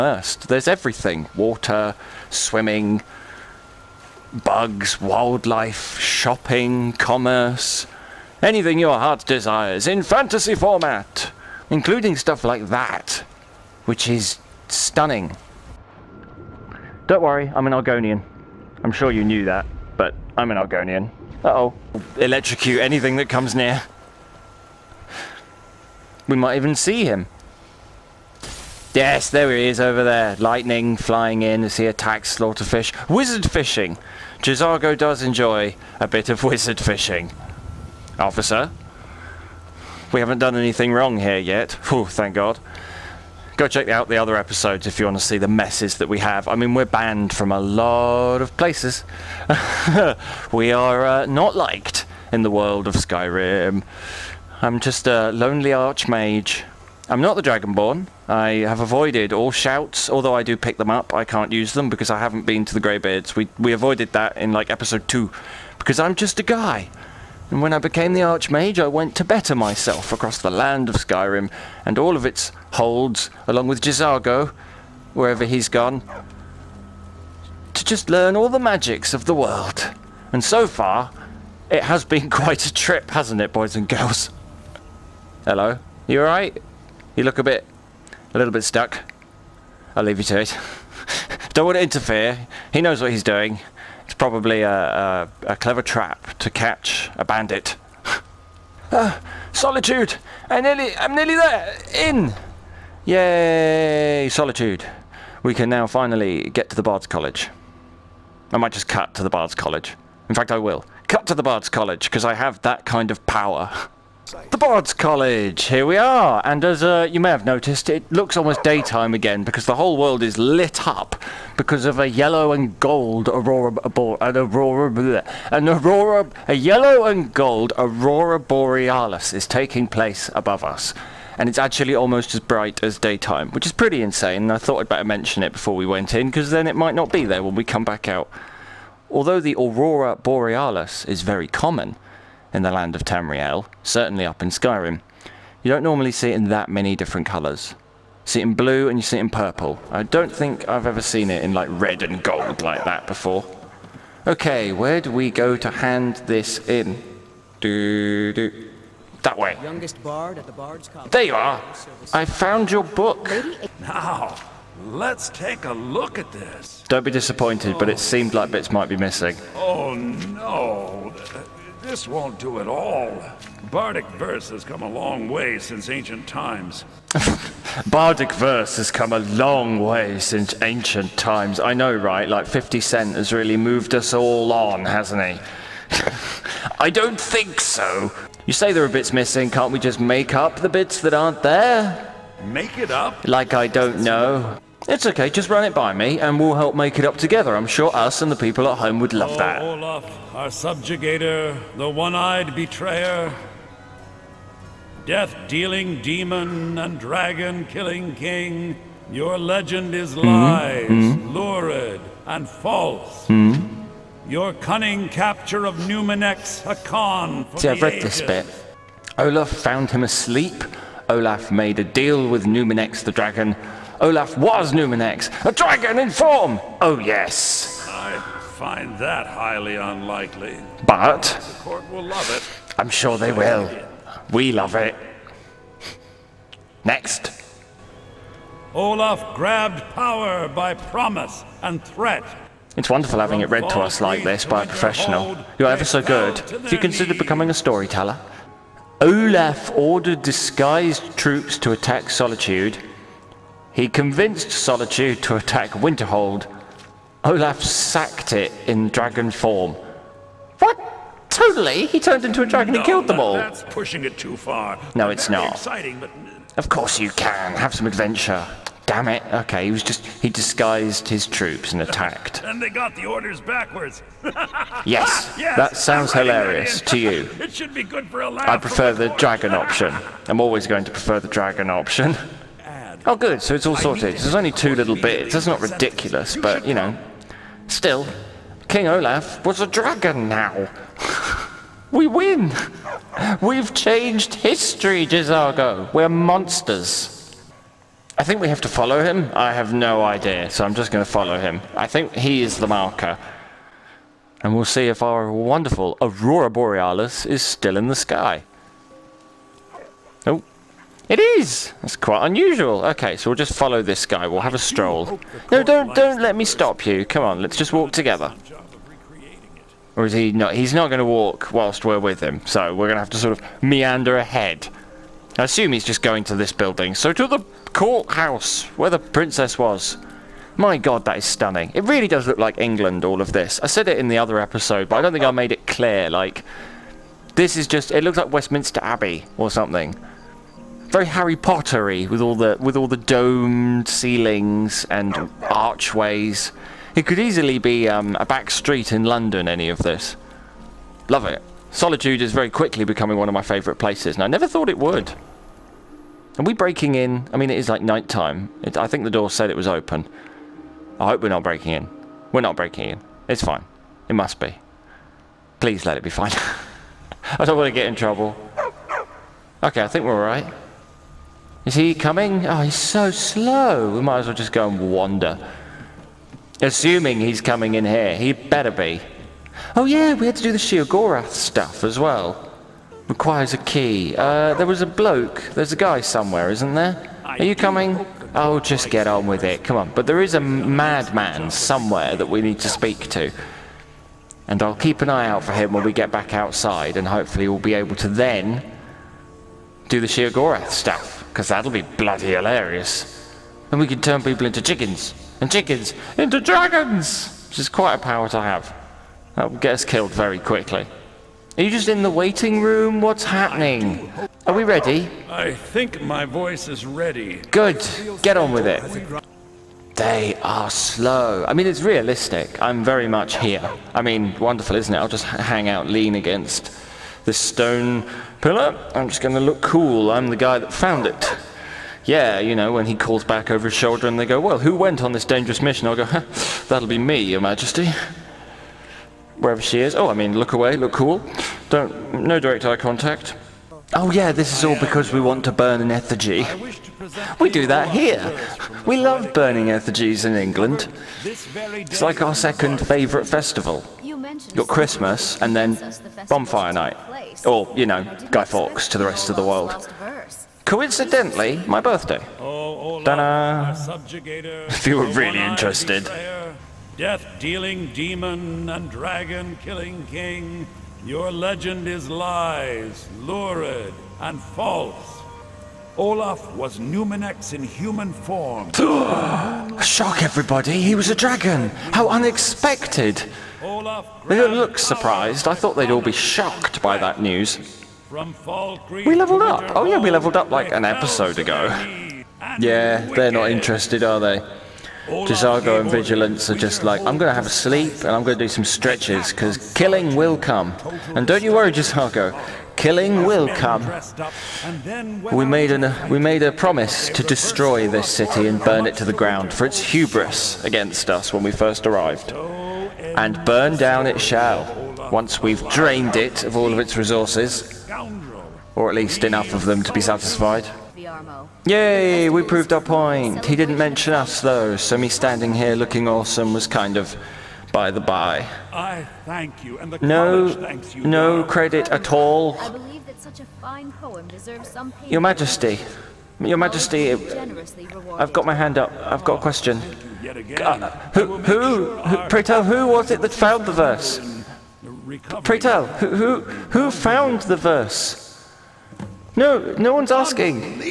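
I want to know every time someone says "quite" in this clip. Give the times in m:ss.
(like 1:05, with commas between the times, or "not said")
1:22, 5:11, 6:47.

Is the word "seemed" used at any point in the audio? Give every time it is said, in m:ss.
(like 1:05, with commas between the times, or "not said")
2:47.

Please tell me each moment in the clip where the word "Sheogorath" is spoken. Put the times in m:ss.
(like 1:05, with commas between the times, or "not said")
6:20, 6:40.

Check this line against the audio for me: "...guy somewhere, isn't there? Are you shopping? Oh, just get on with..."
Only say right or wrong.
wrong.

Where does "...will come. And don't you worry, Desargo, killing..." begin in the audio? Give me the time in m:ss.
8:20.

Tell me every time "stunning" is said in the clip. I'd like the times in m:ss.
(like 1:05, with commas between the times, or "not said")
0:14, 5:31.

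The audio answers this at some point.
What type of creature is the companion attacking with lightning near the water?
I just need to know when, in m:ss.
0:32.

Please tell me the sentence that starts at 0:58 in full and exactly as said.
I have avoided all shouts, although I do pick them up.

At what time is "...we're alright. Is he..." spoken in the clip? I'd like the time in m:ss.
6:10.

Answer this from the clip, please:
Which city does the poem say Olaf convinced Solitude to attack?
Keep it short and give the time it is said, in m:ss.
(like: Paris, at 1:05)
Winterhold, at 4:15.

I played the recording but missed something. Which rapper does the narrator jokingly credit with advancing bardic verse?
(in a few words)
50 Cent.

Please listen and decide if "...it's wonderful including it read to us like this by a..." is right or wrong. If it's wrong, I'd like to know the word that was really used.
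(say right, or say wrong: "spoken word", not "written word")
wrong: "having", not "including".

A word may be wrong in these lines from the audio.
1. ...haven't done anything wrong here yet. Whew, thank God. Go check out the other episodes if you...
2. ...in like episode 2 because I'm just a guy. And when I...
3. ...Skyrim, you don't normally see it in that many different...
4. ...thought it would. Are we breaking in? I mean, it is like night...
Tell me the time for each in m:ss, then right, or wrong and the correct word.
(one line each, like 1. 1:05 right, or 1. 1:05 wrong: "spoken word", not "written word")
1. 0:40 right
2. 1:04 right
3. 2:24 right
4. 5:54 right.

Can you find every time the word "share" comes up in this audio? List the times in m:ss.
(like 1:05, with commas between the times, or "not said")
not said.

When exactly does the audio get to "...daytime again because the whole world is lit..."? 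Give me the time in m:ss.
1:58.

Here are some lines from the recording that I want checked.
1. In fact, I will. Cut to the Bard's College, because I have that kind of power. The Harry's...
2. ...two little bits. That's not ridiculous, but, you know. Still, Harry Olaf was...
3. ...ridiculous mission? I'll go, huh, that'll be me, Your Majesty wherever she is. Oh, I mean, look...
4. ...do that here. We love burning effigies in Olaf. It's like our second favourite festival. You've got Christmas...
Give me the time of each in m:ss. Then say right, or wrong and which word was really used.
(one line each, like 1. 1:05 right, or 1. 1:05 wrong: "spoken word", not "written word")
1. 1:50 wrong: "Bard", not "Harry"
2. 4:44 wrong: "King", not "Harry"
3. 7:15 wrong: "dangerous", not "ridiculous"
4. 7:27 wrong: "England", not "Olaf".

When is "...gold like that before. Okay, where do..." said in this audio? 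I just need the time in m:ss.
2:32.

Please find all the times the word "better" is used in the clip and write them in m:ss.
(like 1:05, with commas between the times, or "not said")
1:09, 2:14, 6:18.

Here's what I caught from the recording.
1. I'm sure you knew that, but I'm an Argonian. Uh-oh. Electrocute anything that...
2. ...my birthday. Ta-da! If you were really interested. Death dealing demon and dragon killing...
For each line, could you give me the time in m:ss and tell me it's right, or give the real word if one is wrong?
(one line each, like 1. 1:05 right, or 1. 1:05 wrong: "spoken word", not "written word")
1. 0:18 right
2. 7:41 right.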